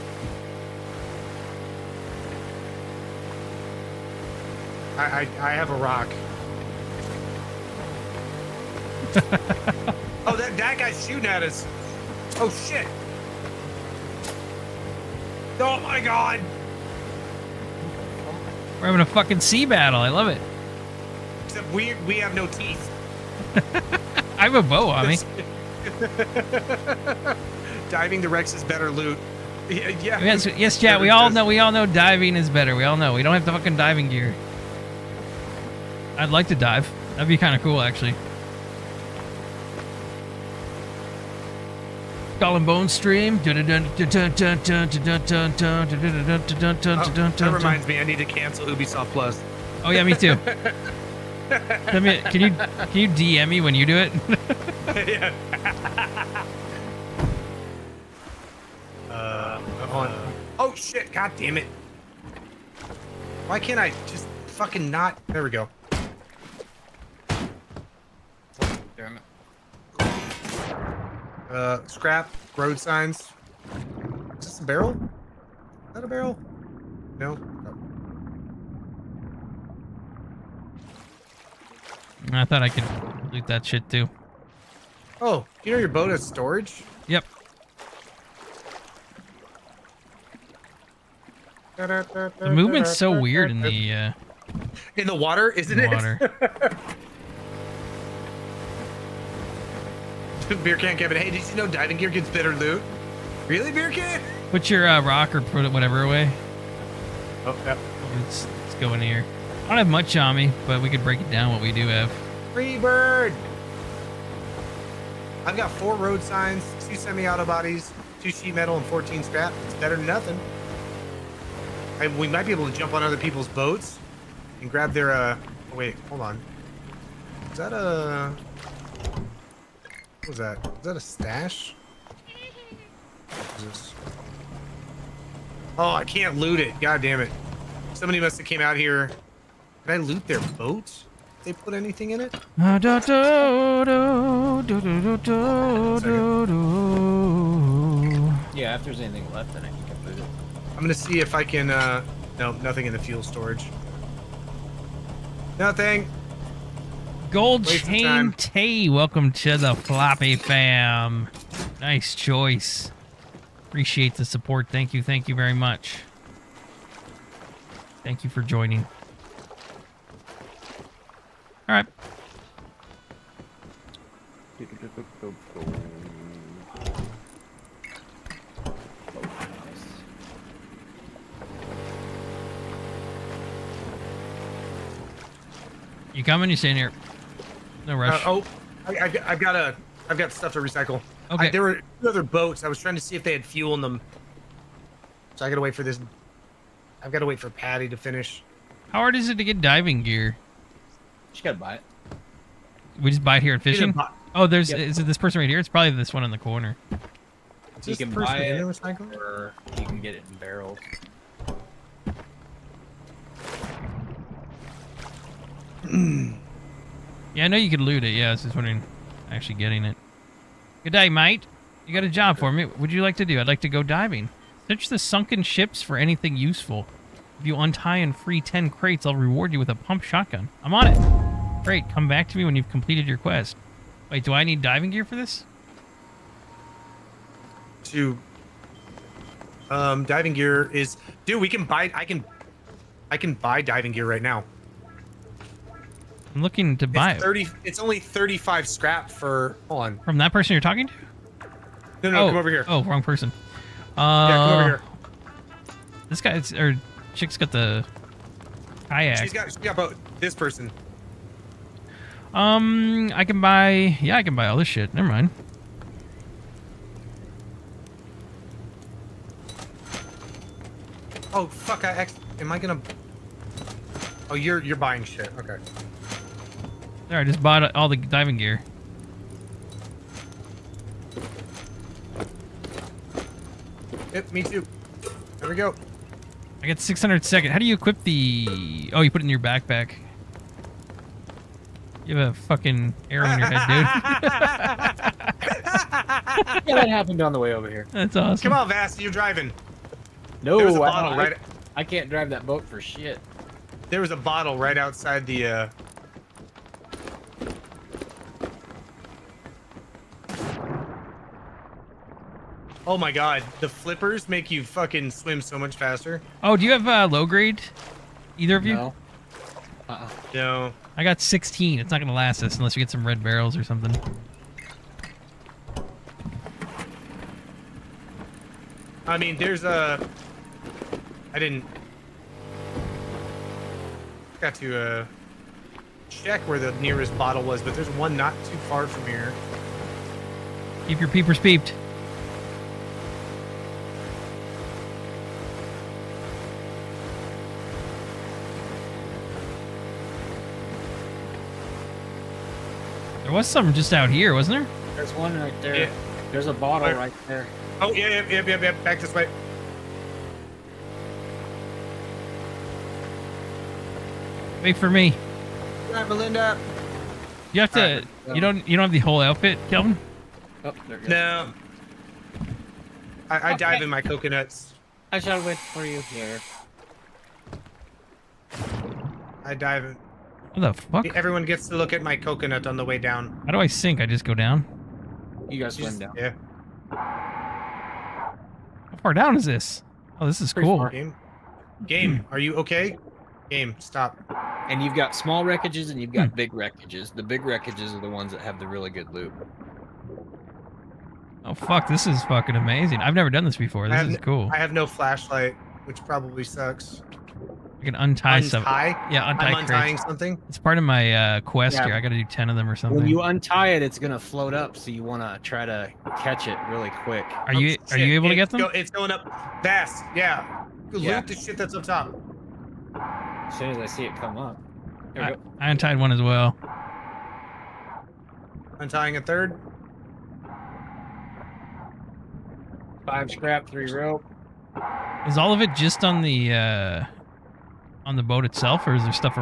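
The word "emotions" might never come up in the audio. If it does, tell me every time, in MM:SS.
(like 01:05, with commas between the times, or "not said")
not said.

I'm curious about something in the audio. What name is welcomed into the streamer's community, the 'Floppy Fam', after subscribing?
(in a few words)
Gold Waste Chain T.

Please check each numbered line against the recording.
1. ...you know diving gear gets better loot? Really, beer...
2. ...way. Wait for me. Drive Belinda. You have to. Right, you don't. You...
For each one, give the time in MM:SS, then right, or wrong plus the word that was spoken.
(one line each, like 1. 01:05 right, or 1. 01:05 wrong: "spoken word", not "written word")
1. 01:41 right
2. 05:59 right.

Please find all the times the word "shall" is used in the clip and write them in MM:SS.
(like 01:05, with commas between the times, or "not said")
06:15.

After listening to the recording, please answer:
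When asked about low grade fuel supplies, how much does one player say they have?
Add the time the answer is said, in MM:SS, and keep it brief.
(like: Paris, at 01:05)
16, at 05:20.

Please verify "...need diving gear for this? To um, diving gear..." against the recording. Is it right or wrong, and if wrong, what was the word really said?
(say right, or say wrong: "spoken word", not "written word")
right.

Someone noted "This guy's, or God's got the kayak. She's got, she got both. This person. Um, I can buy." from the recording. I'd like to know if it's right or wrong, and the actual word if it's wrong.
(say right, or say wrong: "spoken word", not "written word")
wrong: "Chick", not "God".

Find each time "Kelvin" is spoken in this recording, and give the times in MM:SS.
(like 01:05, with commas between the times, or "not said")
06:09.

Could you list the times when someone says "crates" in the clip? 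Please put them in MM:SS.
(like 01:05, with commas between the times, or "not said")
03:48, 06:49.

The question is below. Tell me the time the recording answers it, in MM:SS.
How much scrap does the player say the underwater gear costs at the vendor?
04:07.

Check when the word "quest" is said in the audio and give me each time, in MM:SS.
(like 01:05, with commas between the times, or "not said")
03:53, 06:51.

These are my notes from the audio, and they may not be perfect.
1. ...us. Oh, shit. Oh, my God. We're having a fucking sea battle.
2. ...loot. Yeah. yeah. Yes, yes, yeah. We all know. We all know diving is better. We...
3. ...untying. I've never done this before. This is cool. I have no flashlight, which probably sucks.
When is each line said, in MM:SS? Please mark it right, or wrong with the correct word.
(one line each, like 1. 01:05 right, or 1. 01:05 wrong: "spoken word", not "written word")
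1. 00:11 right
2. 00:28 right
3. 06:42 wrong: "amazing", not "untying".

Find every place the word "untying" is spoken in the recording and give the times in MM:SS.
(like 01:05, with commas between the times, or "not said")
06:49, 07:08.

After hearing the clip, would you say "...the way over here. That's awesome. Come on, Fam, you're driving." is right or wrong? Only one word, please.
wrong.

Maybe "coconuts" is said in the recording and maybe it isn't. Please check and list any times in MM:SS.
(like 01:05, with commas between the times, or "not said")
06:13, 06:22.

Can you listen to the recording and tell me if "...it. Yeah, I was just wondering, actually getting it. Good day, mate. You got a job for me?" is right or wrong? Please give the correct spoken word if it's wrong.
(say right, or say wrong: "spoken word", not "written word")
right.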